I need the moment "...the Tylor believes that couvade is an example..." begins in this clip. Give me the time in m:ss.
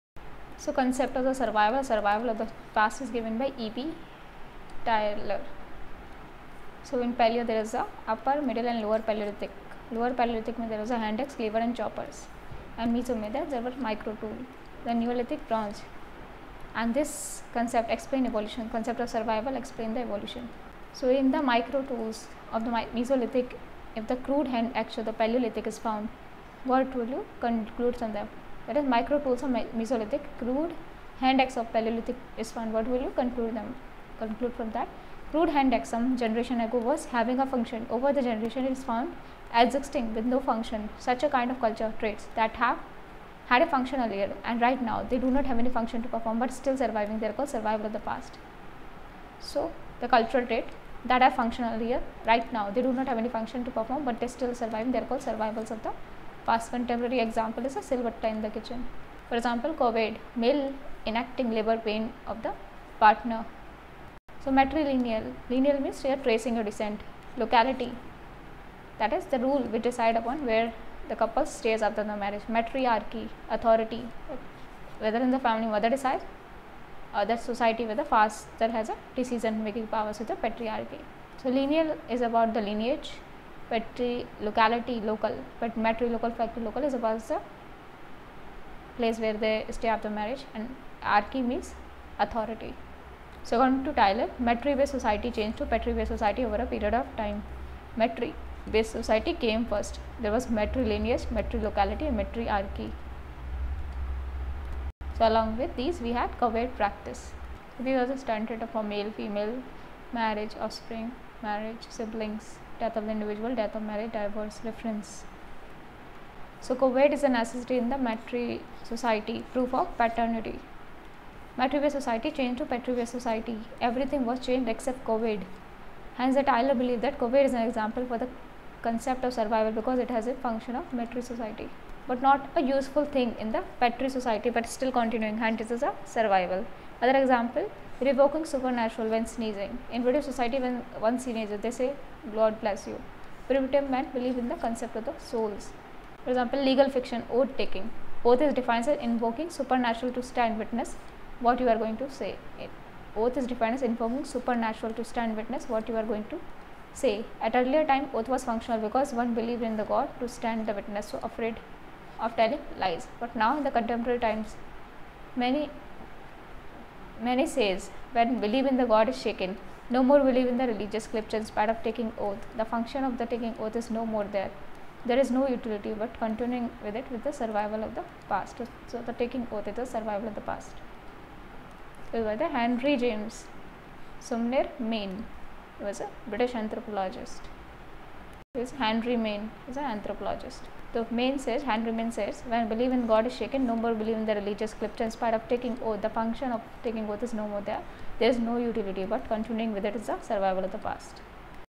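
2:06.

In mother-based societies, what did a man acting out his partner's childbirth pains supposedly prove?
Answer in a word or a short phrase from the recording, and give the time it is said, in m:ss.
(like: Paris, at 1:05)
proof of paternity, at 1:59.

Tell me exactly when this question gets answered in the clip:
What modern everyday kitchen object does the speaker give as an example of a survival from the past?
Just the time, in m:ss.
0:57.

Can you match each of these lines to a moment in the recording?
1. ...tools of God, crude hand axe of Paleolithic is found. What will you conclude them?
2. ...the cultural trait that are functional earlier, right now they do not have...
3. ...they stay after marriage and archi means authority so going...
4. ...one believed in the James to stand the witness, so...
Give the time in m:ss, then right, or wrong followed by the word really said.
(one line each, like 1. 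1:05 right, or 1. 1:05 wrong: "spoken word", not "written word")
1. 0:29 wrong: "Mesolithic", not "God"
2. 0:49 right
3. 1:29 right
4. 2:39 wrong: "God", not "James".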